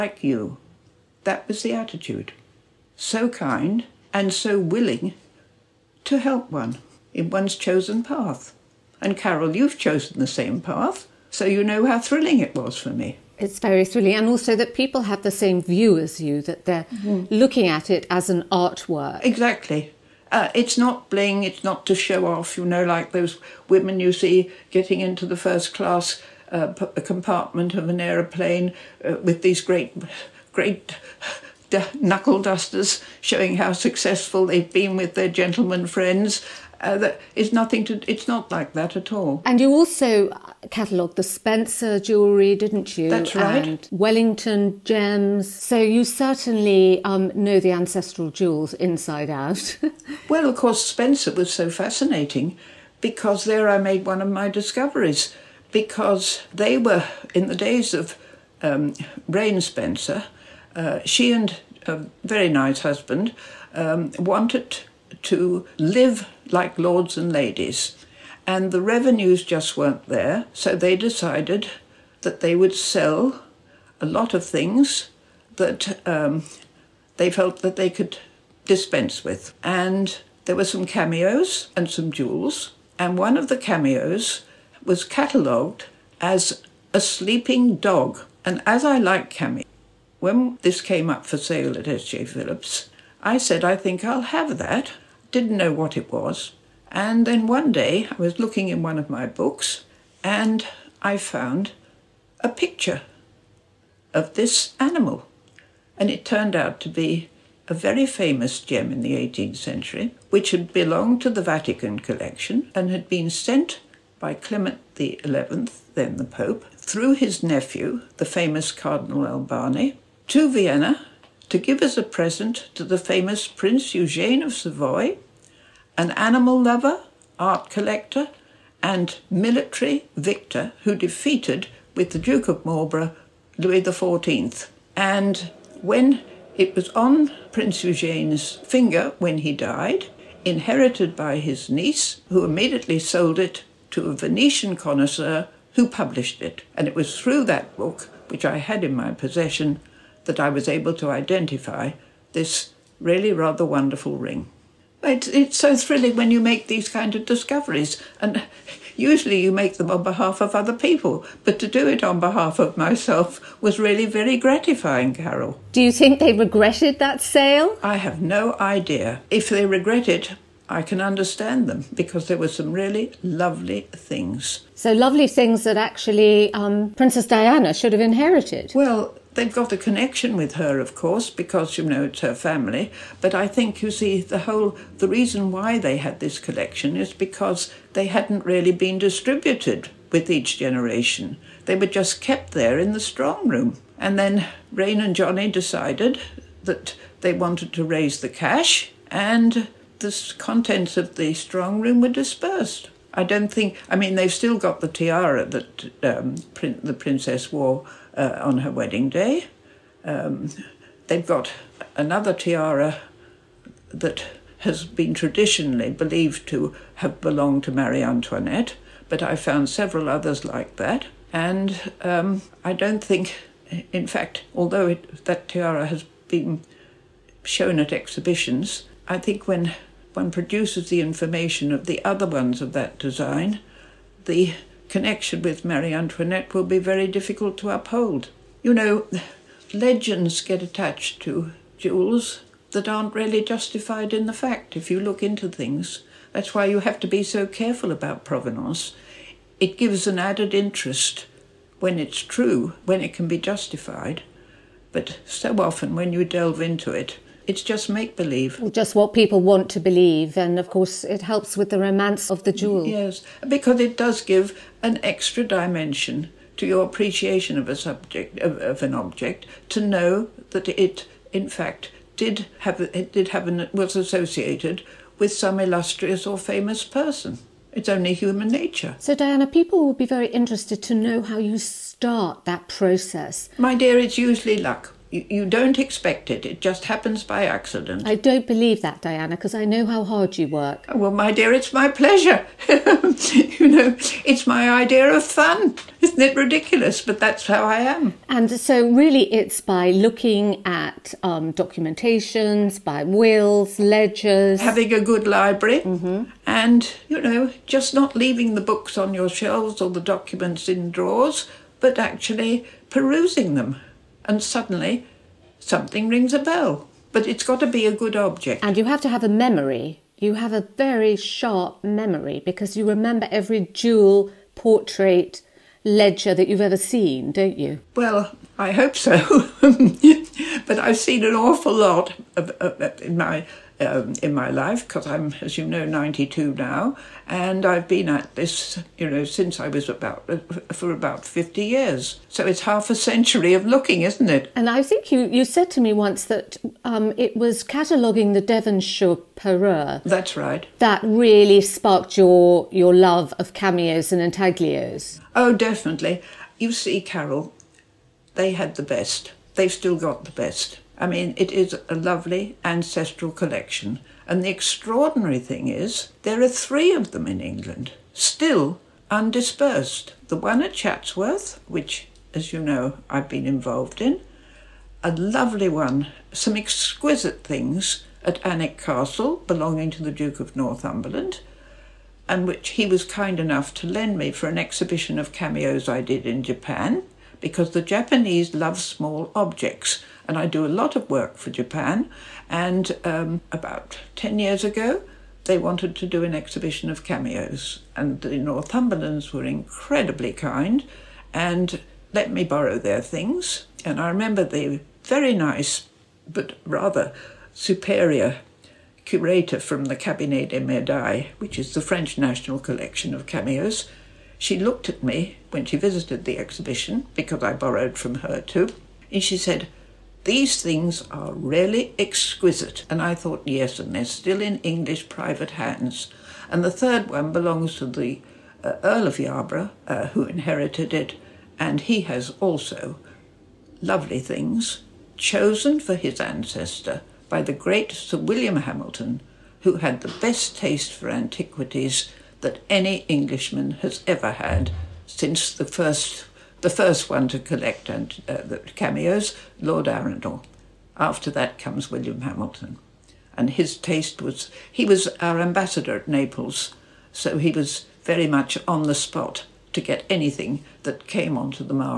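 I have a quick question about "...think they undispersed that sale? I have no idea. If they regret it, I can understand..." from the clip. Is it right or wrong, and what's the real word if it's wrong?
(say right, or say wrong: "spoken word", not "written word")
wrong: "regretted", not "undispersed".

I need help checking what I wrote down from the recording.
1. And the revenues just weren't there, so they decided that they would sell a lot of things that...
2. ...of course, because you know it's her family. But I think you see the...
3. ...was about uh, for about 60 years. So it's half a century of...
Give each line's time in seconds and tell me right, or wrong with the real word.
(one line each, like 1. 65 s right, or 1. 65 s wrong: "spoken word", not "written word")
1. 68 s right
2. 180 s right
3. 339 s wrong: "50", not "60".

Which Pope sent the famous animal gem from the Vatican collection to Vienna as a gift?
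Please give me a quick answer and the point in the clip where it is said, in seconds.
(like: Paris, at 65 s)
Clement XI, at 114 s.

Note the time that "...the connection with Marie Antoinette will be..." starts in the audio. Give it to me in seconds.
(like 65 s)
234 s.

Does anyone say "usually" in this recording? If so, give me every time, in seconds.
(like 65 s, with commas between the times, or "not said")
158 s, 284 s.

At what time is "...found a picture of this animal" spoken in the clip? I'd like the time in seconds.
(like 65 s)
101 s.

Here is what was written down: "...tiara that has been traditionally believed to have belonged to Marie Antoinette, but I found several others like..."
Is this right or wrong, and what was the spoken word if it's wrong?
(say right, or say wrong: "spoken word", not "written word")
right.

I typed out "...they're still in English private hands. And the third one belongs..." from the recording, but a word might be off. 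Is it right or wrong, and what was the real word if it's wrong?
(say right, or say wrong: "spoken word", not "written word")
right.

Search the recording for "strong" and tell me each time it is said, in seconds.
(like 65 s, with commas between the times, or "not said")
193 s, 201 s.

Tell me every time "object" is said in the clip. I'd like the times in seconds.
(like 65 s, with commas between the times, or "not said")
268 s, 318 s, 389 s.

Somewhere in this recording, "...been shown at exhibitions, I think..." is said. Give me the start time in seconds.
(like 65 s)
226 s.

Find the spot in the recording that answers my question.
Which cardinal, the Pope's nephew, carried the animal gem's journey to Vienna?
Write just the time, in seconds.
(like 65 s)
118 s.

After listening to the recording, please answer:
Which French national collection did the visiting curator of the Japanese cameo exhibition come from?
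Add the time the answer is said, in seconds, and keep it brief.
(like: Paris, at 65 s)
Cabinet des Medailles, at 409 s.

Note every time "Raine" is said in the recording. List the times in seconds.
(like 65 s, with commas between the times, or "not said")
59 s, 194 s.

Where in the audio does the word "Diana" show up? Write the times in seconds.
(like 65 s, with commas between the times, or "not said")
177 s, 279 s, 289 s.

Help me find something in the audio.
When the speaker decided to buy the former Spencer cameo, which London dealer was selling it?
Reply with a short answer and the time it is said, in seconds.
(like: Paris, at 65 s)
S.J. Phillips, at 91 s.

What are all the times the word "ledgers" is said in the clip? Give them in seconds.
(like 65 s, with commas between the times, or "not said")
303 s, 325 s.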